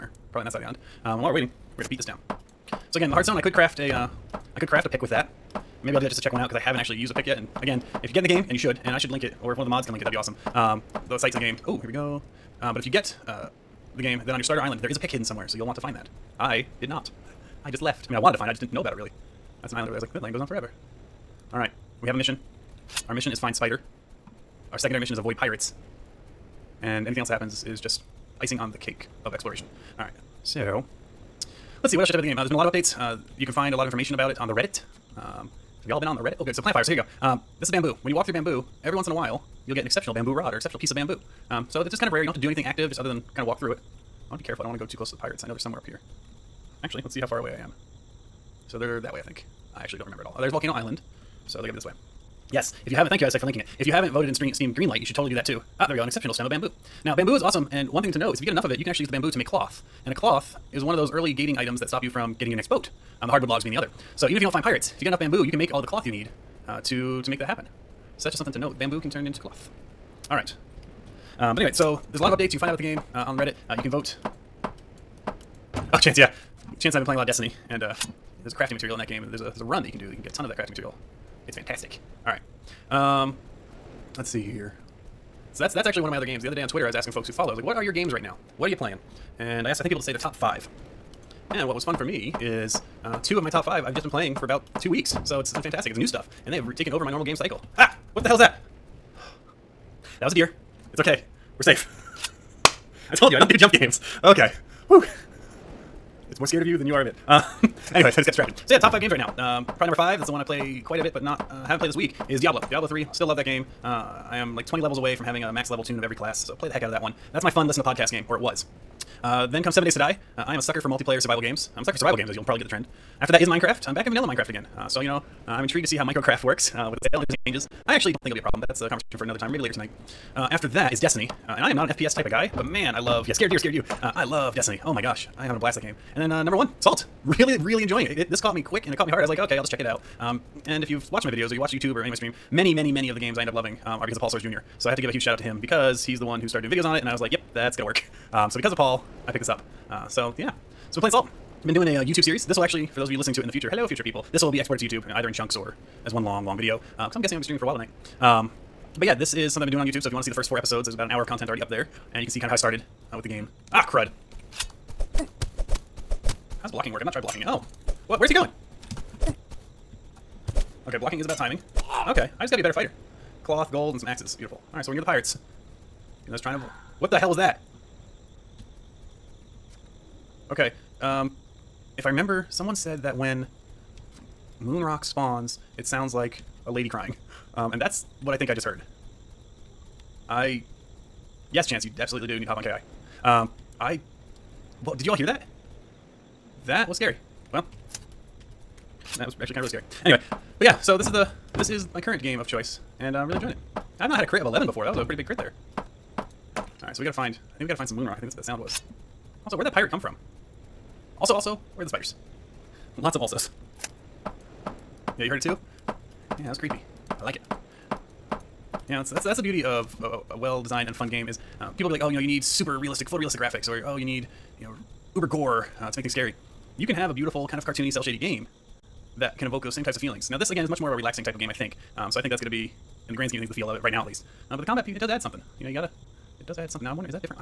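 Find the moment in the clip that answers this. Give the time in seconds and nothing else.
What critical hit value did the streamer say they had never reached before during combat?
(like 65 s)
204 s.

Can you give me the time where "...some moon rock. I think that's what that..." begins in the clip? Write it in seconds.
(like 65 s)
207 s.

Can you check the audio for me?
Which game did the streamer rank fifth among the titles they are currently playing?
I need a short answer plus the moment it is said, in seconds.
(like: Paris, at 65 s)
Diablo 3, at 112 s.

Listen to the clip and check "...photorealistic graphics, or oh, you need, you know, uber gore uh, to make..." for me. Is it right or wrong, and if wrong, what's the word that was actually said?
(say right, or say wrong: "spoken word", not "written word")
right.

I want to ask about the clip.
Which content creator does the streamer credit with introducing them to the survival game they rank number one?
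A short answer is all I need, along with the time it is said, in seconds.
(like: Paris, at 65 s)
Paul Soares Jr., at 144 s.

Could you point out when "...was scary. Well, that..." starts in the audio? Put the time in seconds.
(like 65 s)
196 s.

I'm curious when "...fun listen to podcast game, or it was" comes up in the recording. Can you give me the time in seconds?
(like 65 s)
117 s.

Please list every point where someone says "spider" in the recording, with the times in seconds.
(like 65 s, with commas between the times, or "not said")
23 s, 211 s.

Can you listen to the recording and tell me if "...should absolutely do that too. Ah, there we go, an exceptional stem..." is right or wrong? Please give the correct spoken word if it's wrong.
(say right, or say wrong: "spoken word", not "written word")
wrong: "totally", not "absolutely".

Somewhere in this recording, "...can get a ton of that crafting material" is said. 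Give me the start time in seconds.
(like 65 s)
80 s.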